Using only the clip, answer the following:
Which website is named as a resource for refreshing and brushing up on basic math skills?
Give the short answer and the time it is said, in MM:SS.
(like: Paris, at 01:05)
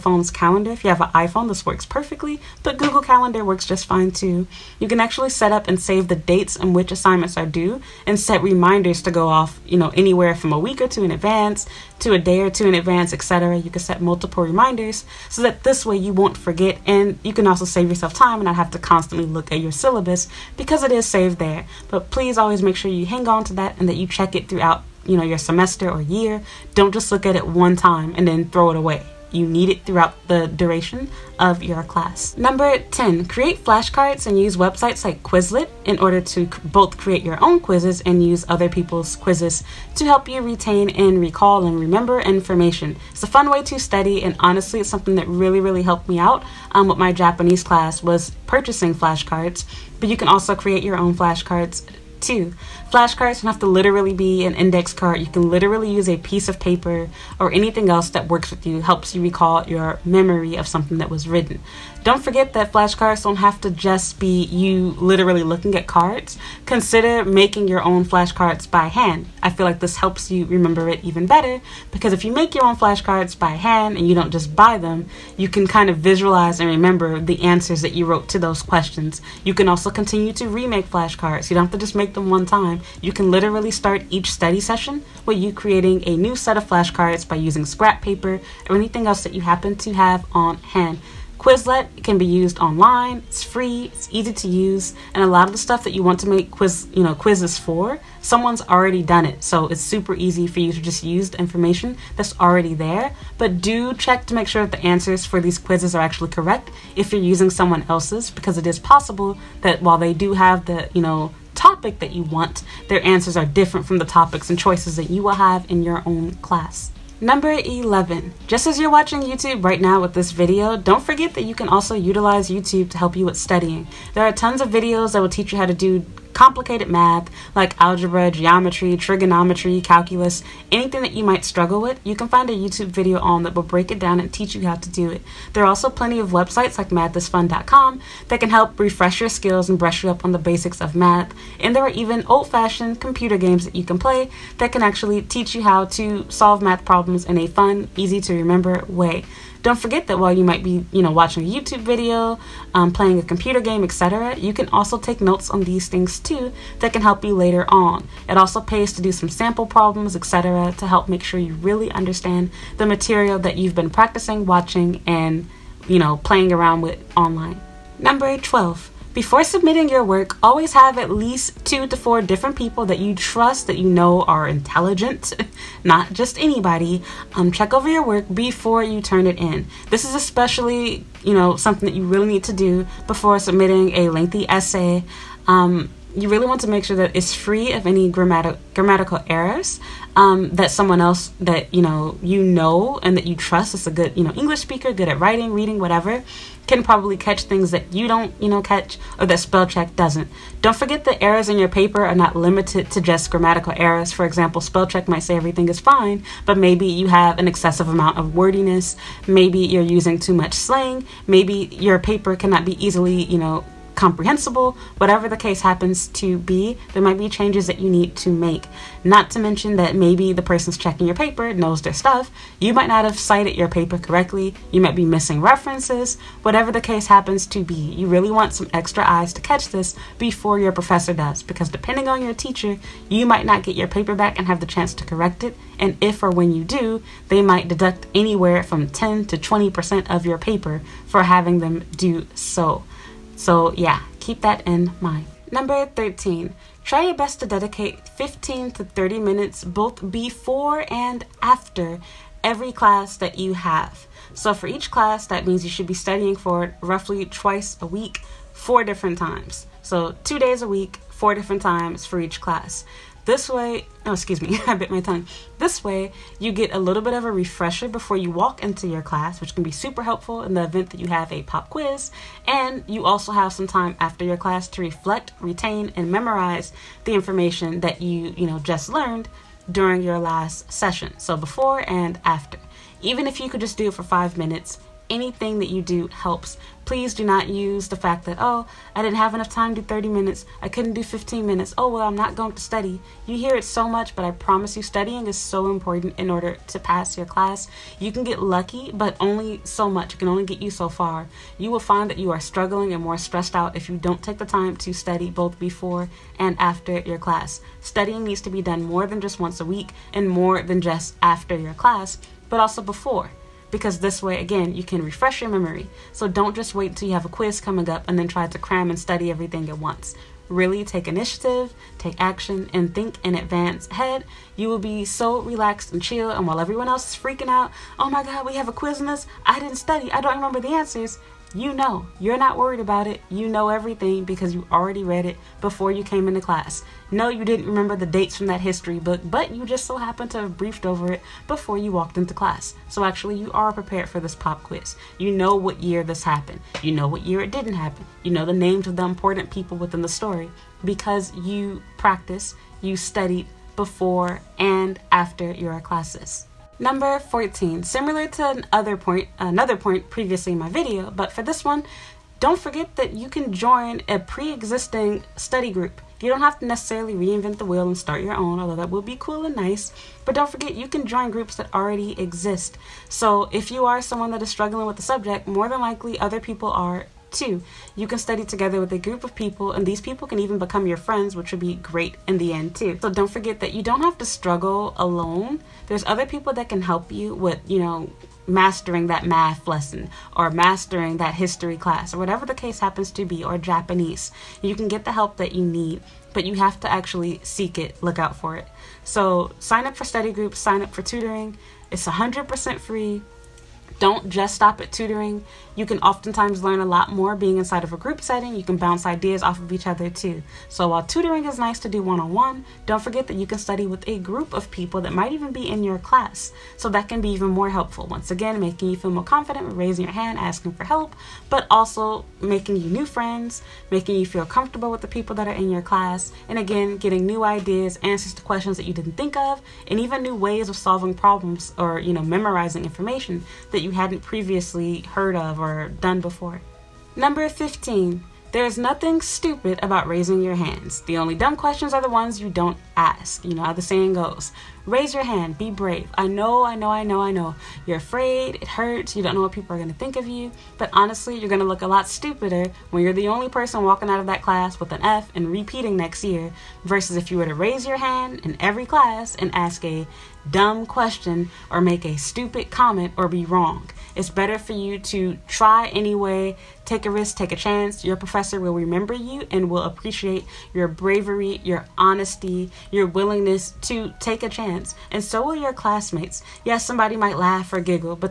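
mathisfun.com, at 02:16.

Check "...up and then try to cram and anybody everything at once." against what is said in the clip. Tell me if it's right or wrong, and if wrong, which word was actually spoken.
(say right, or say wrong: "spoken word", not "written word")
wrong: "study", not "anybody".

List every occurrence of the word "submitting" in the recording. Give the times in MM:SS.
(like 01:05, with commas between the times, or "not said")
02:49, 03:03.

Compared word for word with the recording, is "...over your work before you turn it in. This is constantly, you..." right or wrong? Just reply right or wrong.
wrong.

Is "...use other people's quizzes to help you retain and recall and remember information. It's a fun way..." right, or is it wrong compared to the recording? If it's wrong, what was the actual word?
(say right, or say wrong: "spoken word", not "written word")
right.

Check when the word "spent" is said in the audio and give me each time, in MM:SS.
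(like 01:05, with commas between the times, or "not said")
not said.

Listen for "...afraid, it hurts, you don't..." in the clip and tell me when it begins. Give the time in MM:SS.
07:27.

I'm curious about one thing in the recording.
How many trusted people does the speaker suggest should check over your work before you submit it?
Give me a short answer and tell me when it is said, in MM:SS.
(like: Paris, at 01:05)
2 to 4, at 02:51.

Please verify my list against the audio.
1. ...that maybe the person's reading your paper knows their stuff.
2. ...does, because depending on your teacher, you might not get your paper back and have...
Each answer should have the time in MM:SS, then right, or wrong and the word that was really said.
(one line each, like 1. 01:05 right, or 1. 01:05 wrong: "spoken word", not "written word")
1. 03:39 wrong: "checking", not "reading"
2. 03:51 right.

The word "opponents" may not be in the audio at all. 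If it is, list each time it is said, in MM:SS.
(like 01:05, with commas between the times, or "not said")
not said.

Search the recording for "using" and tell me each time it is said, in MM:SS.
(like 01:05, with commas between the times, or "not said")
01:27, 01:47, 03:29.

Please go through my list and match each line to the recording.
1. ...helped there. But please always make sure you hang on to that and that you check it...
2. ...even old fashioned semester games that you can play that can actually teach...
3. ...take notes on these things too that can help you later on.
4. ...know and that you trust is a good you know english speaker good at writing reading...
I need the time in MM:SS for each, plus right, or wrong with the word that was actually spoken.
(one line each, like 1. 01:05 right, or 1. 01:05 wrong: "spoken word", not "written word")
1. 00:21 wrong: "saved", not "helped"
2. 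02:21 wrong: "computer", not "semester"
3. 02:34 right
4. 03:12 right.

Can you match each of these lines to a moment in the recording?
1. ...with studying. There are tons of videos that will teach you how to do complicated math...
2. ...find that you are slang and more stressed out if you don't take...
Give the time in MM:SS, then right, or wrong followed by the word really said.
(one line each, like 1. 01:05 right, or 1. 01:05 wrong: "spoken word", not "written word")
1. 02:03 right
2. 05:01 wrong: "struggling", not "slang".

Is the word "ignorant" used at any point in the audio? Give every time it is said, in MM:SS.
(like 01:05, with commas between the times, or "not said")
not said.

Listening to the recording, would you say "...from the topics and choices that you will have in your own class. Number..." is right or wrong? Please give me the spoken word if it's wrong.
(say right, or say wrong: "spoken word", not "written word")
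right.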